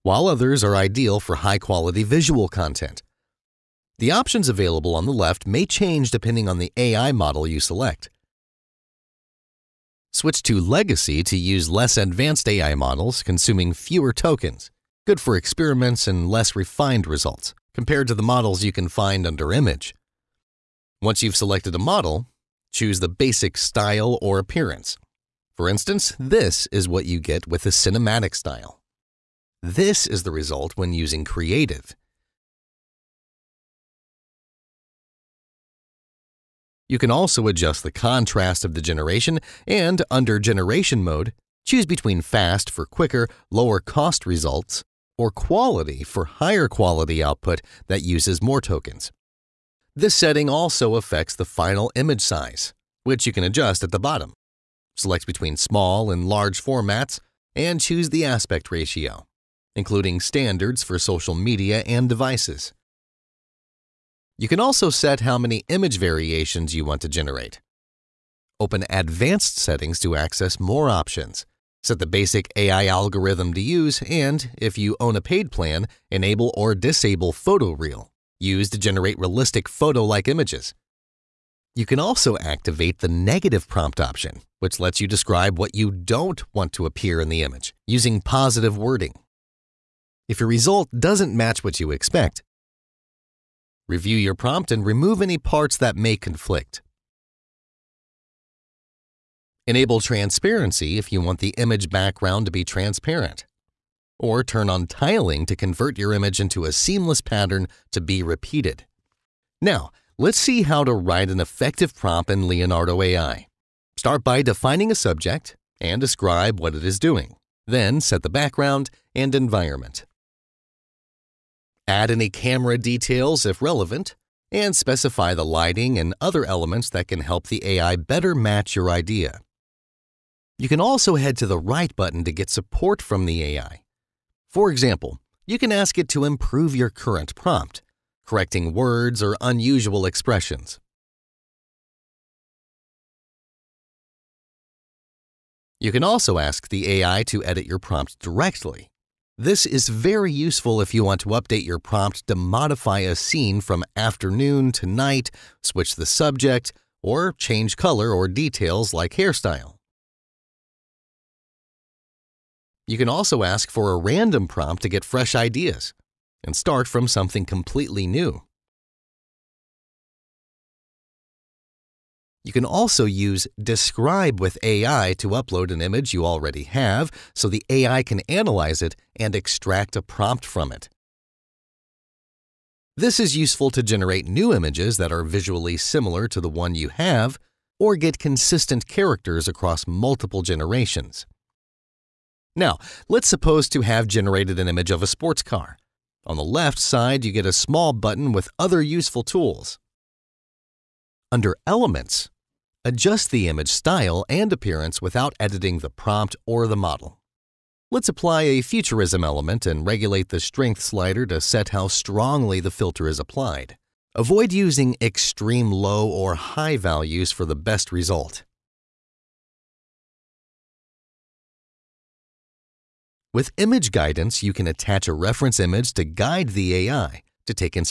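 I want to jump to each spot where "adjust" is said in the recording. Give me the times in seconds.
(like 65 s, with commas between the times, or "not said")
37 s, 53 s, 202 s.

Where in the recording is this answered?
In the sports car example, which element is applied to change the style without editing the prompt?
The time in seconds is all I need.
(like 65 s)
208 s.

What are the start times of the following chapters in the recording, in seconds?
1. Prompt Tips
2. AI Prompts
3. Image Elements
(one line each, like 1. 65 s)
1. 108 s
2. 129 s
3. 191 s.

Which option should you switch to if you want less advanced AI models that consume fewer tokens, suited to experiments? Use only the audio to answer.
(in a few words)
Legacy.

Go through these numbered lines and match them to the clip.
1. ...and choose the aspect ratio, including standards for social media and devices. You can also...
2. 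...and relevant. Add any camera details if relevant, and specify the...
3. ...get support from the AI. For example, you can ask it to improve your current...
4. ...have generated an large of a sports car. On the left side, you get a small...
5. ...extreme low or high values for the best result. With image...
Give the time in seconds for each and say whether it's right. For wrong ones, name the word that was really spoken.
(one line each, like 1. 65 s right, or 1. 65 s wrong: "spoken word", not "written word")
1. 57 s right
2. 119 s wrong: "environment", not "relevant"
3. 132 s right
4. 193 s wrong: "image", not "large"
5. 214 s right.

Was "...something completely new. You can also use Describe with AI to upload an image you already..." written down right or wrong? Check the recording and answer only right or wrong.
right.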